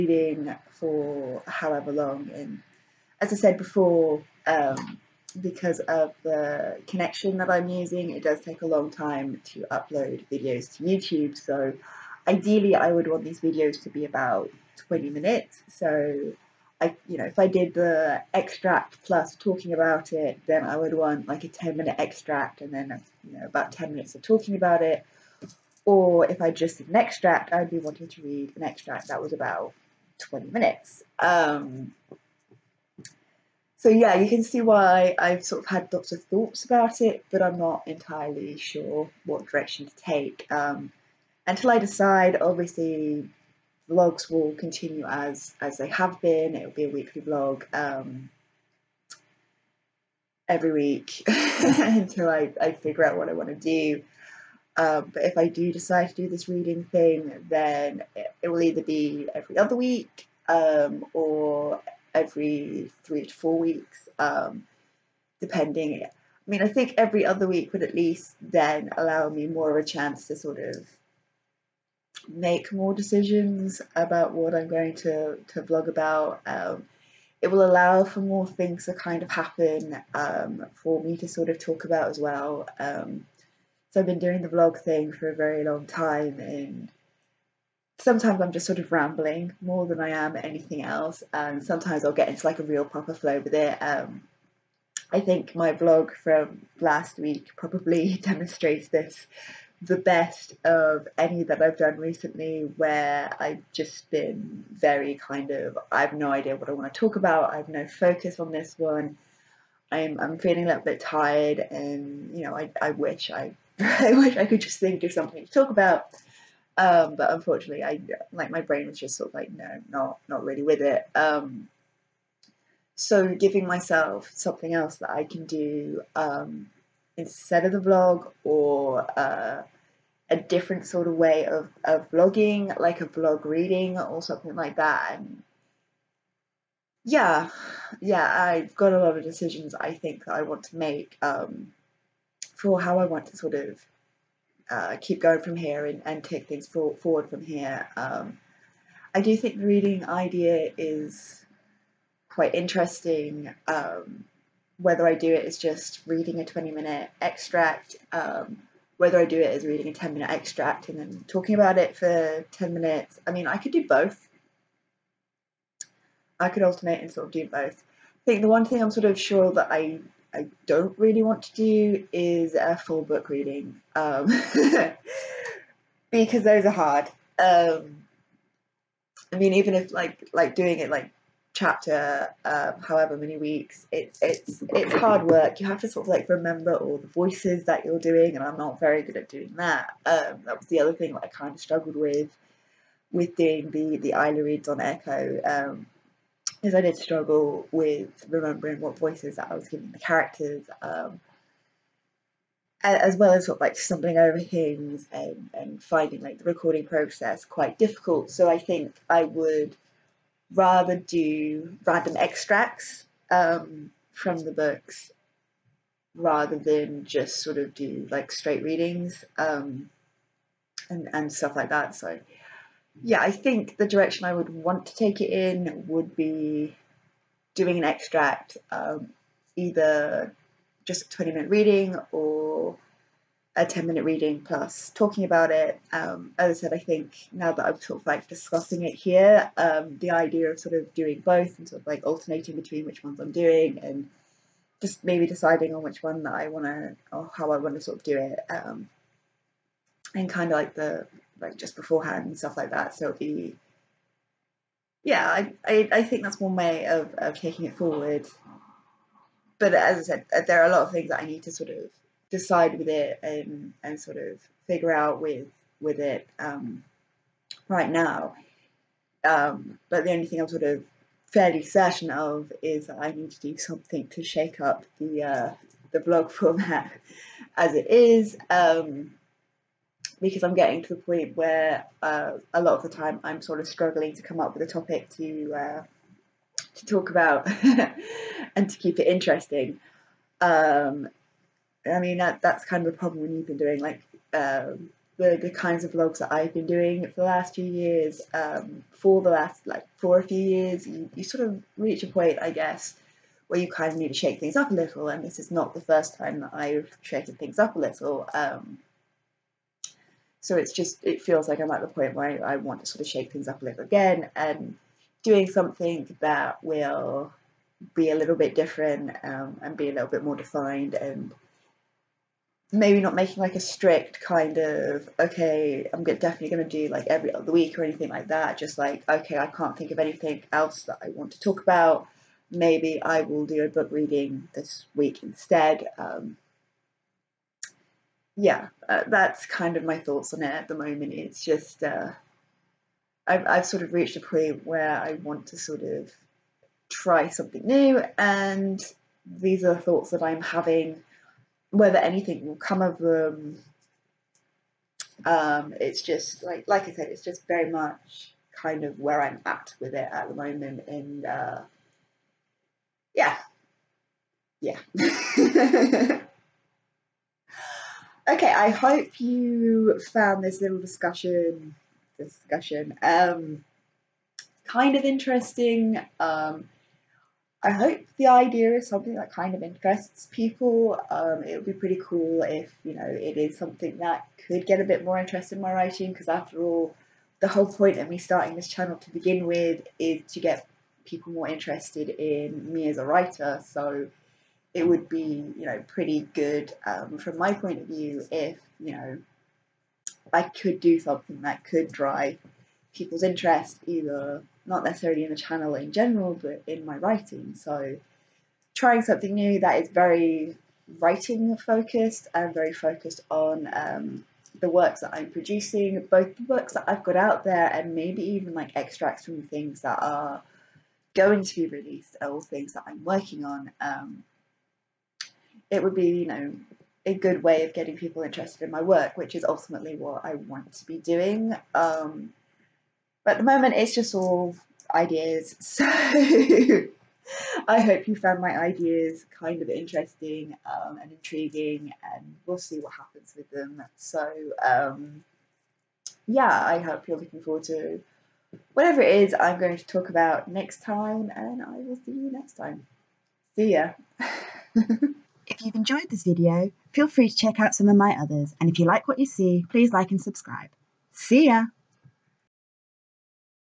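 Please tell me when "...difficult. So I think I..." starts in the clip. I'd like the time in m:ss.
3:27.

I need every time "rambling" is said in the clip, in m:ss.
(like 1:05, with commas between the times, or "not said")
1:28.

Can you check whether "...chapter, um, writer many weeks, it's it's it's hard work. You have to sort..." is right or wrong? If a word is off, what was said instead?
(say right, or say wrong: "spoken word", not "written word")
wrong: "however", not "writer".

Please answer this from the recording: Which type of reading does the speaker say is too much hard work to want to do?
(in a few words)
full book reading.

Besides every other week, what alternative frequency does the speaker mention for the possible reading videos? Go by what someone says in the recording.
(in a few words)
every three to four weeks.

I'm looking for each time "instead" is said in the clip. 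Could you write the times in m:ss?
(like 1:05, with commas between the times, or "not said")
2:07, 5:35.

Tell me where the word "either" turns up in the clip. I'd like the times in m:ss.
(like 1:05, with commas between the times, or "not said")
0:58, 3:49, 6:43.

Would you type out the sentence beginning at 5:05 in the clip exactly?
And this is not the first time that I've shaken things up a little.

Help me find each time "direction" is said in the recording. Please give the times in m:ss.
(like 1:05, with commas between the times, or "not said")
0:39, 3:43.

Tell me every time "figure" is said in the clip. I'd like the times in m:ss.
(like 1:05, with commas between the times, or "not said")
0:52, 4:24.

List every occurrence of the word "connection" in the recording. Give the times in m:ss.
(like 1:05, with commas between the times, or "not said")
0:06.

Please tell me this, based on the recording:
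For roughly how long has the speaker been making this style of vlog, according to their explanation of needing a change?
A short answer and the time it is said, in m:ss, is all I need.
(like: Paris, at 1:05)
a few years, at 5:00.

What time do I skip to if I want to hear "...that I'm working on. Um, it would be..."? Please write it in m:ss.
7:02.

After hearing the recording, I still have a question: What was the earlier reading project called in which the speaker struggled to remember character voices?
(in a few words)
Ila reads.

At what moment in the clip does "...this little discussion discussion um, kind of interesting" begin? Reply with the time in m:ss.
6:10.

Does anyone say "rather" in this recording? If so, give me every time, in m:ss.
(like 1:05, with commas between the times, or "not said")
3:30, 3:36.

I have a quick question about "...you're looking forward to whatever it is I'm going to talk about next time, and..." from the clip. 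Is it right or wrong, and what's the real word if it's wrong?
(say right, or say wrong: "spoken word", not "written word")
right.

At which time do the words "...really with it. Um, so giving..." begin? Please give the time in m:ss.
2:00.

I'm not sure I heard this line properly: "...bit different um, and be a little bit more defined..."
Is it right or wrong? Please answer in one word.
right.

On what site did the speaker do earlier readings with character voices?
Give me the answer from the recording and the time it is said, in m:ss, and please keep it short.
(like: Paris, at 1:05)
Echoe, at 3:14.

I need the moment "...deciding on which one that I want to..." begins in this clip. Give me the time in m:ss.
4:05.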